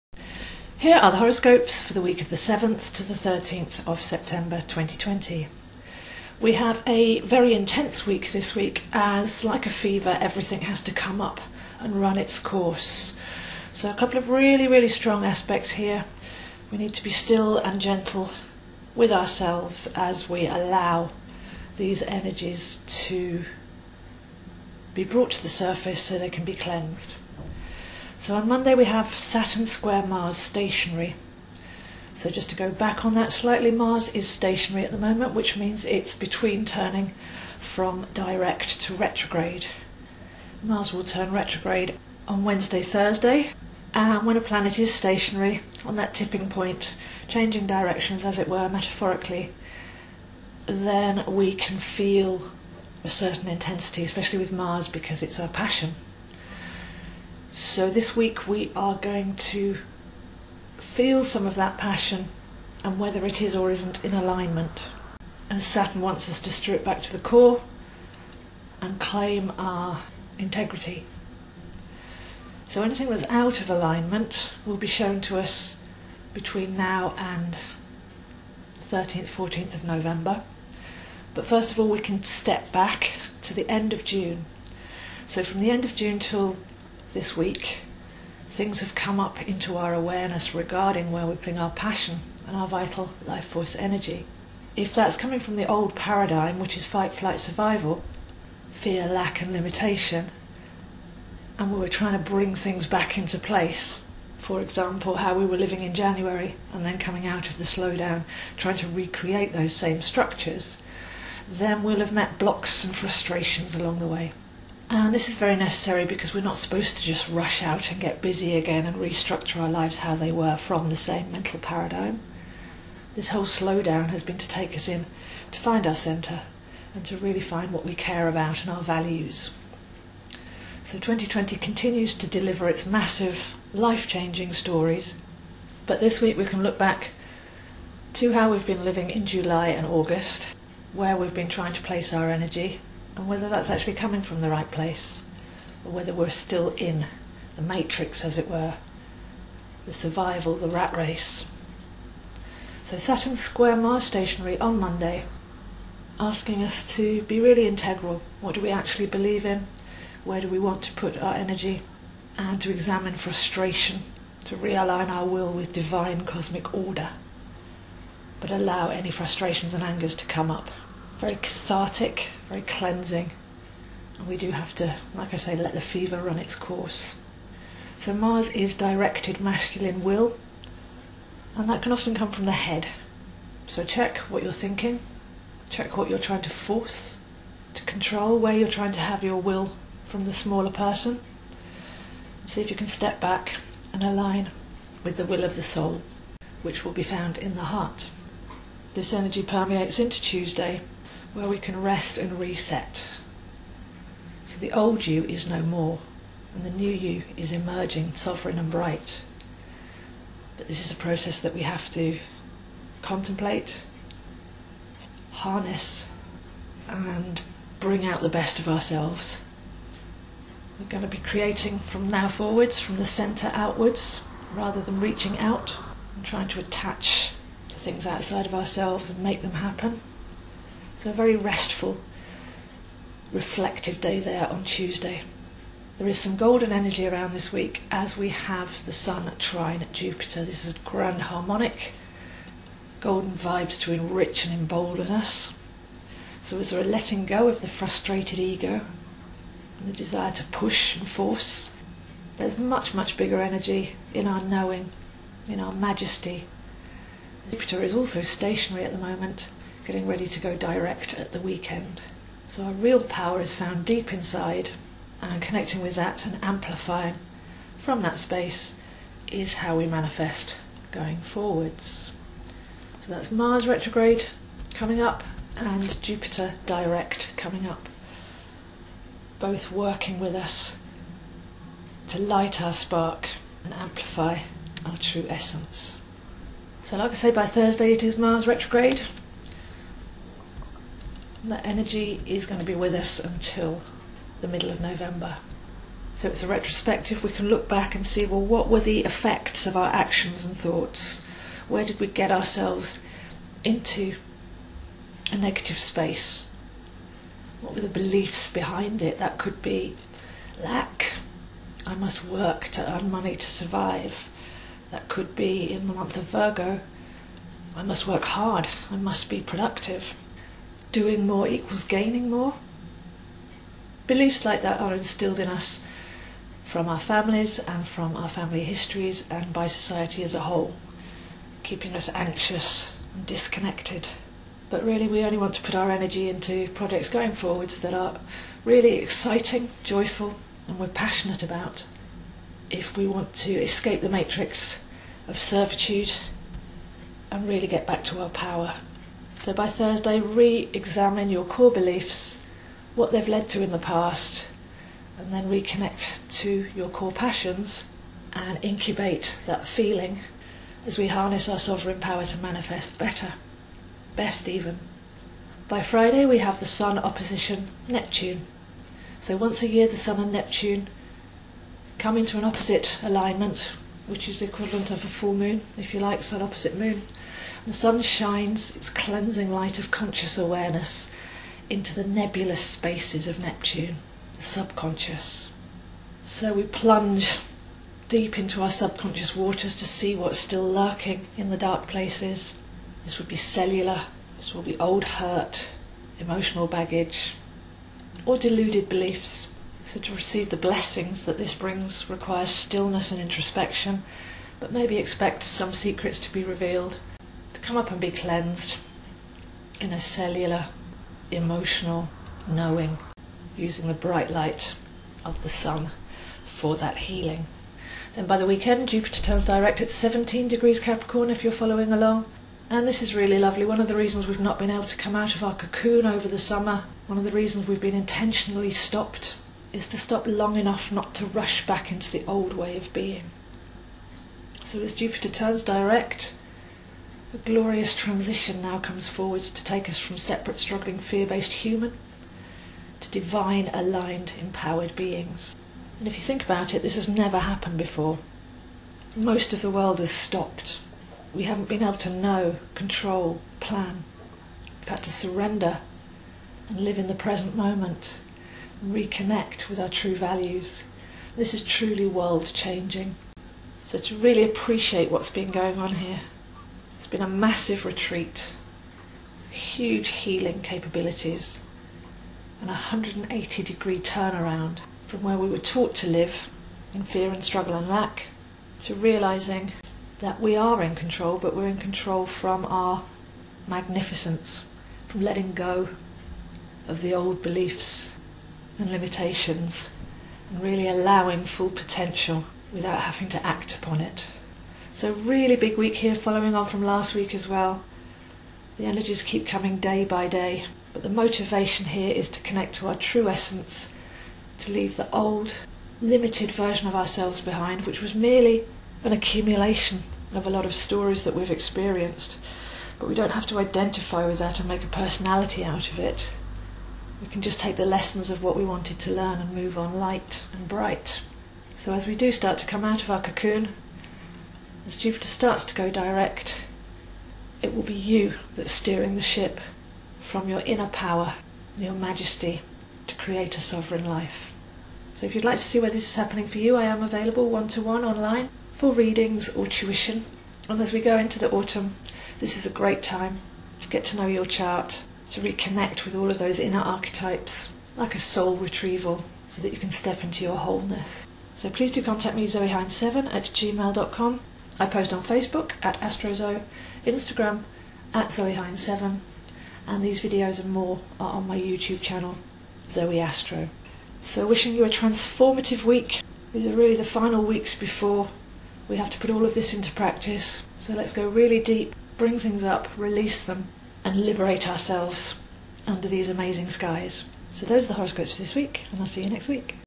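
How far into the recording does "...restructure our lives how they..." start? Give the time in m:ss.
1:58.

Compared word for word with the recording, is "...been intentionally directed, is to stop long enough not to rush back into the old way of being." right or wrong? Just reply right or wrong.
wrong.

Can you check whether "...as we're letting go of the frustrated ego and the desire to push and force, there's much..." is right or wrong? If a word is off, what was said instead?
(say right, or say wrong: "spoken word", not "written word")
right.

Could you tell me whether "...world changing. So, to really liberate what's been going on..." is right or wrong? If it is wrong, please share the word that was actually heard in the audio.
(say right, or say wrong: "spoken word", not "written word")
wrong: "appreciate", not "liberate".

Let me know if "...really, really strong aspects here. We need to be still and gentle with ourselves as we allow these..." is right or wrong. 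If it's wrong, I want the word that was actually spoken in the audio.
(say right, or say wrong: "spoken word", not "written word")
right.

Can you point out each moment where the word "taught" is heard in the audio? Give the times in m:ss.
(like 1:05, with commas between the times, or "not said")
7:55.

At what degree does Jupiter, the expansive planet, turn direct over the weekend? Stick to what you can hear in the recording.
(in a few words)
17 degrees Capricorn.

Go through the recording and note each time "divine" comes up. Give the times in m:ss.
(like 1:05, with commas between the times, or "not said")
2:45, 7:23.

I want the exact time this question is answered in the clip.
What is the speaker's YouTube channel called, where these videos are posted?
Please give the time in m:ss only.
9:22.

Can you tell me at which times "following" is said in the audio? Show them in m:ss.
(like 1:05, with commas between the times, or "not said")
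7:01, 8:16.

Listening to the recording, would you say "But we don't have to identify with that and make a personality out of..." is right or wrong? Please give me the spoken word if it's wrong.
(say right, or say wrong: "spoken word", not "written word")
right.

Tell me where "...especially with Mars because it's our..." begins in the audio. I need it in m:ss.
0:54.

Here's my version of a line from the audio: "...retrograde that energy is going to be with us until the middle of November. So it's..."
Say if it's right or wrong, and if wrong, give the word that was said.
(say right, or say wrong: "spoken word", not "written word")
right.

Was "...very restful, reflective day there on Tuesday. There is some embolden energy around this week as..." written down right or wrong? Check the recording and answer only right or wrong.
wrong.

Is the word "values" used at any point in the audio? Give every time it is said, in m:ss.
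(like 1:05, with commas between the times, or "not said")
2:08, 7:40.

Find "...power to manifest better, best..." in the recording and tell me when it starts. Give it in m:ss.
6:01.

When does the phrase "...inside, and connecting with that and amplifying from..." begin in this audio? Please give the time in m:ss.
4:24.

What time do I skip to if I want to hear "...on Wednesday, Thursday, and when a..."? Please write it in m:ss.
0:42.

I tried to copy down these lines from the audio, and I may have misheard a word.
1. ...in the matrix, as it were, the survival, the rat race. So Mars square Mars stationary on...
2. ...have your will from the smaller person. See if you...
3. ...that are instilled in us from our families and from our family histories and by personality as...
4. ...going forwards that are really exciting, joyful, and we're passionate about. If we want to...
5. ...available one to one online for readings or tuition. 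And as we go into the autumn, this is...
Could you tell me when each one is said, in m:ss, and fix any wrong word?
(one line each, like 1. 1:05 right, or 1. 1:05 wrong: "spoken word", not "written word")
1. 2:26 wrong: "Saturn", not "Mars"
2. 3:08 right
3. 5:24 wrong: "society", not "personality"
4. 5:37 right
5. 8:57 right.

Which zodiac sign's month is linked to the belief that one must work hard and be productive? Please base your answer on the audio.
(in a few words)
Virgo.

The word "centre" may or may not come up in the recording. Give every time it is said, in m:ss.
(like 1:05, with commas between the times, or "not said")
2:05, 3:43.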